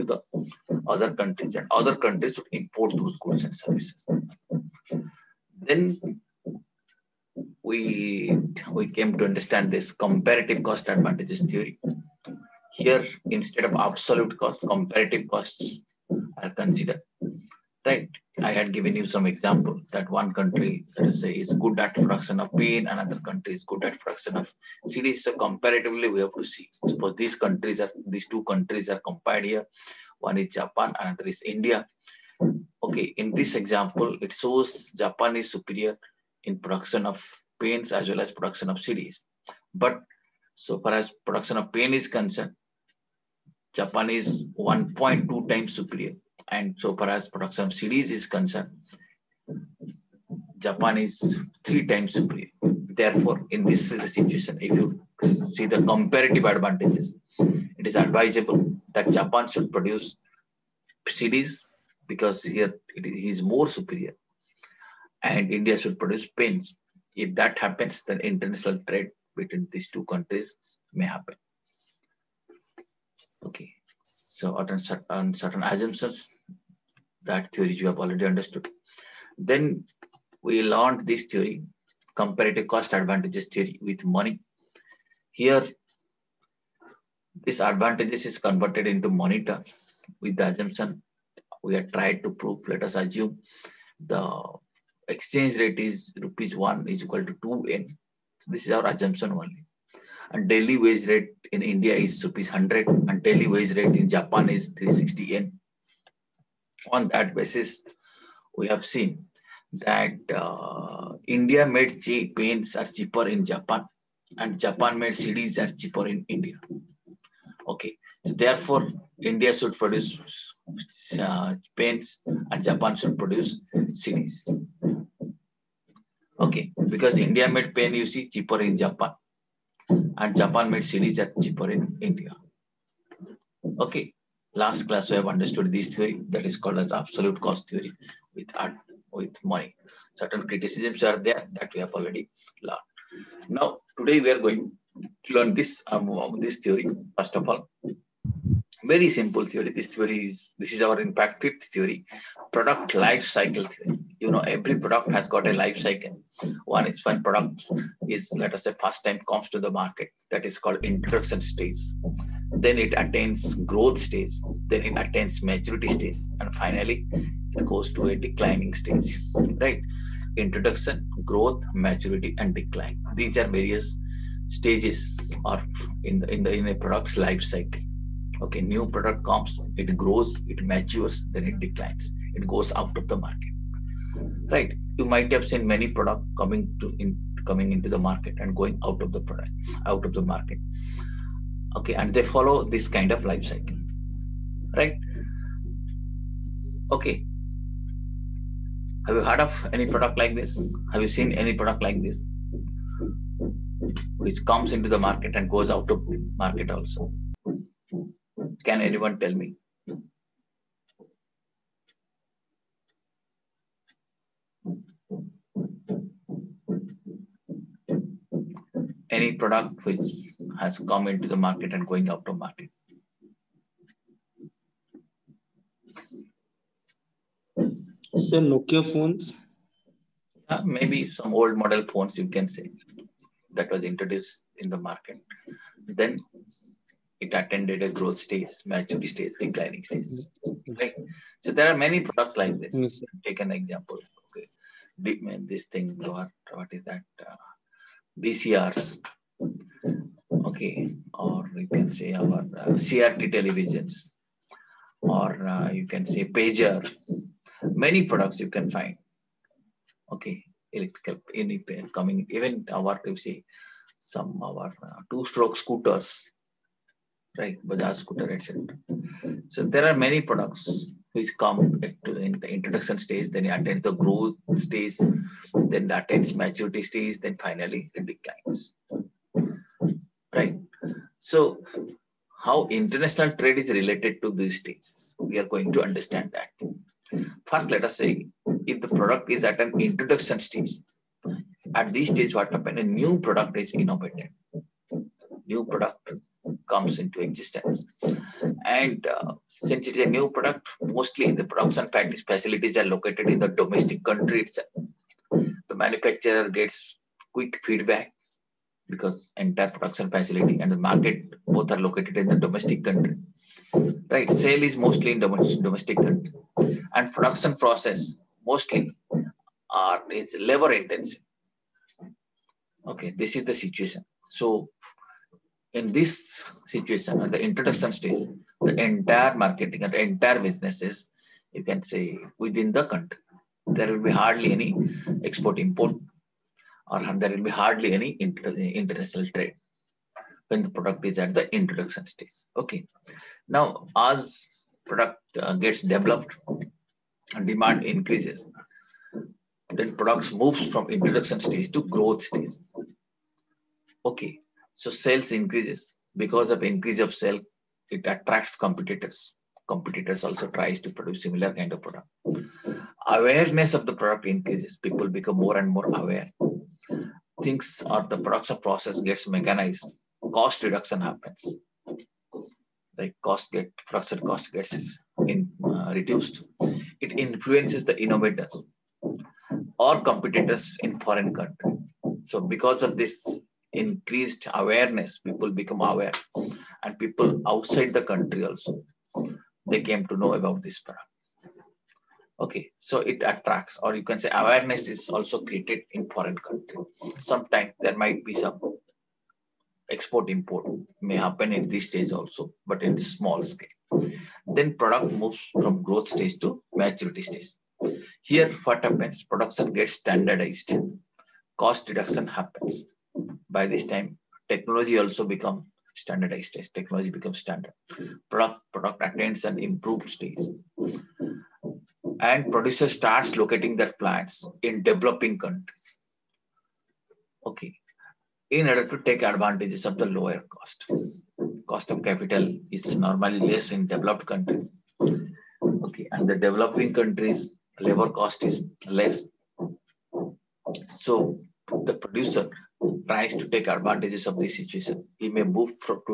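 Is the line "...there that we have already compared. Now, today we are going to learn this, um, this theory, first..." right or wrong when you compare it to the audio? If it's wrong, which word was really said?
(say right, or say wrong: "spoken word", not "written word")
wrong: "learned", not "compared".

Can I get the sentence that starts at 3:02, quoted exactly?
It goes out of the market, right?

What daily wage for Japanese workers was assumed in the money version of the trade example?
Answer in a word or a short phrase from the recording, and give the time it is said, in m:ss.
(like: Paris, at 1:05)
360 yen, at 1:44.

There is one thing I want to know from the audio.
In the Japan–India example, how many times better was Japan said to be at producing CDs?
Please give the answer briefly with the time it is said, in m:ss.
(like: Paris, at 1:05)
3 times, at 0:51.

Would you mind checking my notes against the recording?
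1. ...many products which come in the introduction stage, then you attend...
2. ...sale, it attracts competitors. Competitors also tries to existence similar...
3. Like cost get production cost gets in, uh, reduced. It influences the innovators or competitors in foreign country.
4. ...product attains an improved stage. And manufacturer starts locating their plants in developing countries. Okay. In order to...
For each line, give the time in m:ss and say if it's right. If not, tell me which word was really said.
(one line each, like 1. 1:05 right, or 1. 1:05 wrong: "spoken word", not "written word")
1. 4:29 right
2. 5:57 wrong: "produce", not "existence"
3. 6:12 right
4. 6:58 wrong: "producer", not "manufacturer".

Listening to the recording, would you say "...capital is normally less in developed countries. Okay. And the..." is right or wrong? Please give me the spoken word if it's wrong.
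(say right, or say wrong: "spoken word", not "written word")
right.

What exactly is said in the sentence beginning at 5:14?
Right, sale is mostly in domestic country, and production process mostly are is labor intensive.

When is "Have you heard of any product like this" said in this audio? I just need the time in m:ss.
3:19.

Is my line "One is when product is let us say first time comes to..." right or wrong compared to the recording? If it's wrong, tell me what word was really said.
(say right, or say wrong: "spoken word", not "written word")
right.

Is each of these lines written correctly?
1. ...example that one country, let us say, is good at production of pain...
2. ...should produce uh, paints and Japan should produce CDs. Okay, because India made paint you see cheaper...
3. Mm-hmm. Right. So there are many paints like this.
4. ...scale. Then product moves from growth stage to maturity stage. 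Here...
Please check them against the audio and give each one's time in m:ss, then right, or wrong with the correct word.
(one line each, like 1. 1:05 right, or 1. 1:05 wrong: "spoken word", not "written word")
1. 0:19 right
2. 1:59 right
3. 4:00 wrong: "products", not "paints"
4. 6:43 right.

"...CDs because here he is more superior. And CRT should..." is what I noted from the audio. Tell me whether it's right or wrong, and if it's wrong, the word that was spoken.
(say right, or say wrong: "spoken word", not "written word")
wrong: "India", not "CRT".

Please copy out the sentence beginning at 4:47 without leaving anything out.
First, let us say if the product is at an introduction stage, at this stage, what happens?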